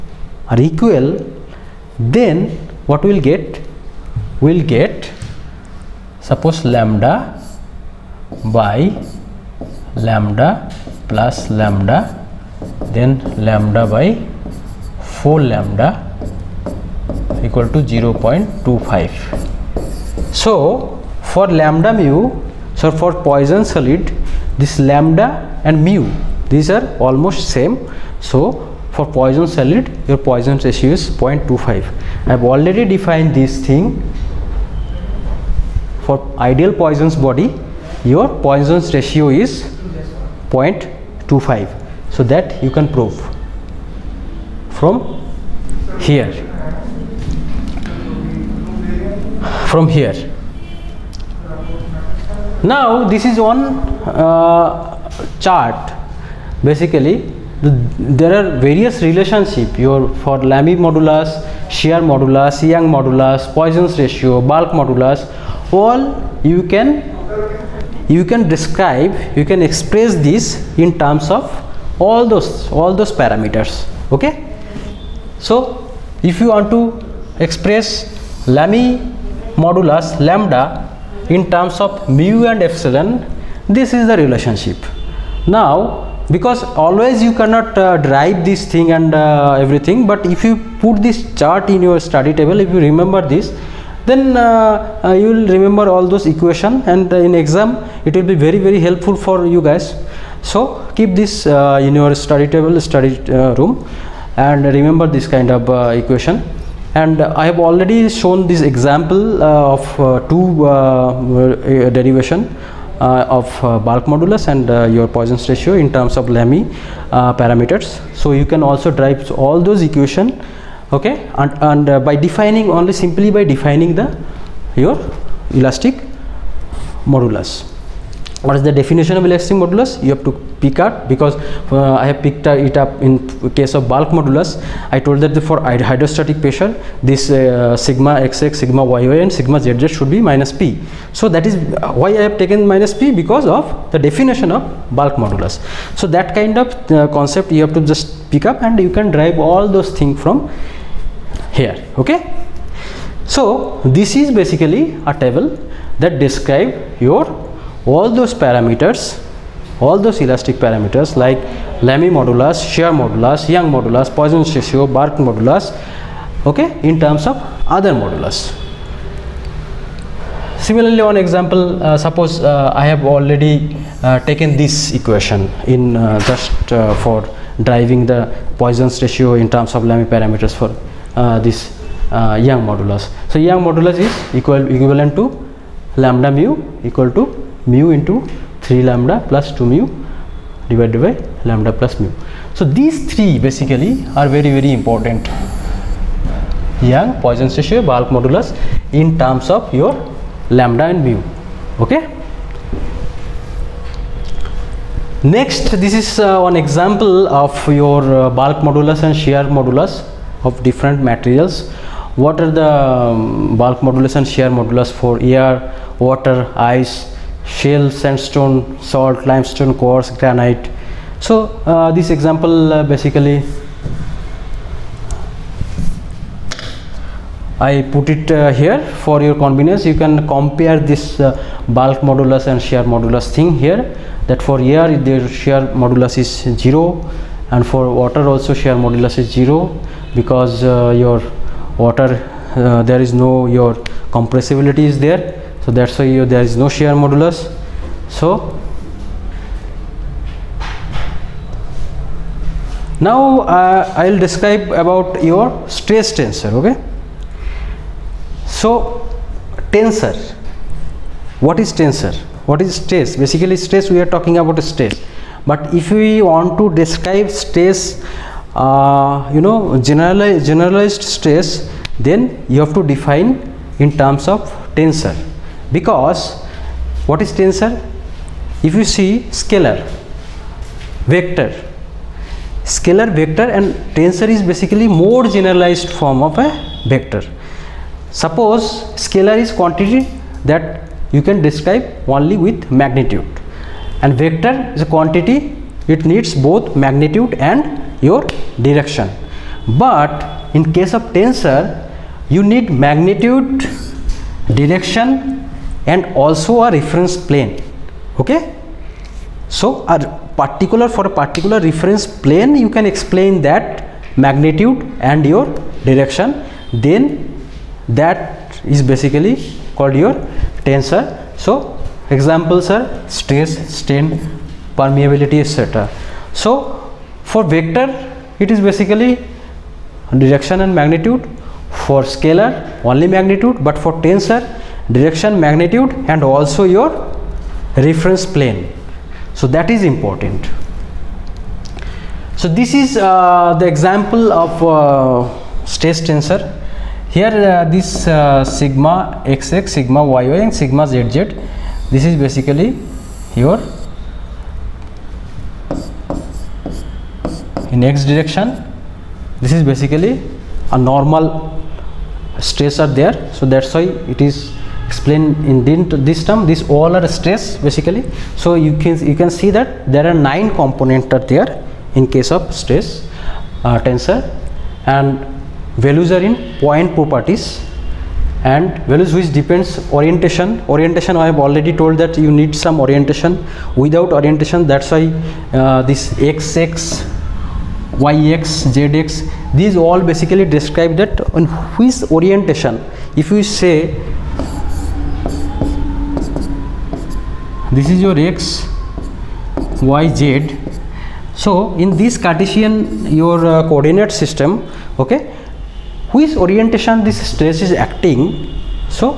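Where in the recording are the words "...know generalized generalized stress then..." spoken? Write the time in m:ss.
4:29.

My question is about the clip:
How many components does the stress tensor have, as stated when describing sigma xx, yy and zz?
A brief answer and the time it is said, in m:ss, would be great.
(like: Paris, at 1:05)
9, at 6:10.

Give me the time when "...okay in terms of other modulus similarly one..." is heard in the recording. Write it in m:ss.
2:46.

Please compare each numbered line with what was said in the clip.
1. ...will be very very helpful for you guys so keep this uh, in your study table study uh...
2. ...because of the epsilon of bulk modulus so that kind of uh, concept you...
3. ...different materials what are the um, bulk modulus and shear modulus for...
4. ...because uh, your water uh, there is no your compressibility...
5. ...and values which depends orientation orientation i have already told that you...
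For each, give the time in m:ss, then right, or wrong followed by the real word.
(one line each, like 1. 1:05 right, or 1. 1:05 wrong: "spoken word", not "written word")
1. 1:38 right
2. 2:23 wrong: "definition", not "epsilon"
3. 3:30 right
4. 4:00 right
5. 6:18 right.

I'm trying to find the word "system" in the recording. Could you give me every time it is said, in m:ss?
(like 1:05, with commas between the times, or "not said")
6:44.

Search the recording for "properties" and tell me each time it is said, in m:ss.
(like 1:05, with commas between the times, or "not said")
6:16.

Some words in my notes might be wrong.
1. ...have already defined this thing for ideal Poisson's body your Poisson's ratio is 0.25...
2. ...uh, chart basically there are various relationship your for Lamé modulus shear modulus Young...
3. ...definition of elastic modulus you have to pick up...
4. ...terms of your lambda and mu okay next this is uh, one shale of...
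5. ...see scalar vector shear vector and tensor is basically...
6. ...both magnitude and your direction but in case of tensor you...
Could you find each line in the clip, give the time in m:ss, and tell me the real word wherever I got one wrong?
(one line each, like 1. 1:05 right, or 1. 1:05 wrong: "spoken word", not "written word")
1. 0:32 right
2. 0:54 right
3. 2:08 right
4. 3:19 wrong: "example", not "shale"
5. 4:38 wrong: "scalar", not "shear"
6. 4:56 right.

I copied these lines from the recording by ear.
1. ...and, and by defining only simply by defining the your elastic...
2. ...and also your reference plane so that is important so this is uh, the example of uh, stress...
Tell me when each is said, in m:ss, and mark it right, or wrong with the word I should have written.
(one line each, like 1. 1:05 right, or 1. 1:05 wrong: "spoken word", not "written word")
1. 2:01 right
2. 5:36 right.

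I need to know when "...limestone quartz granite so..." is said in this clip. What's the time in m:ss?
3:39.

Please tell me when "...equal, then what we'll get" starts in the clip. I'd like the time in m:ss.
0:00.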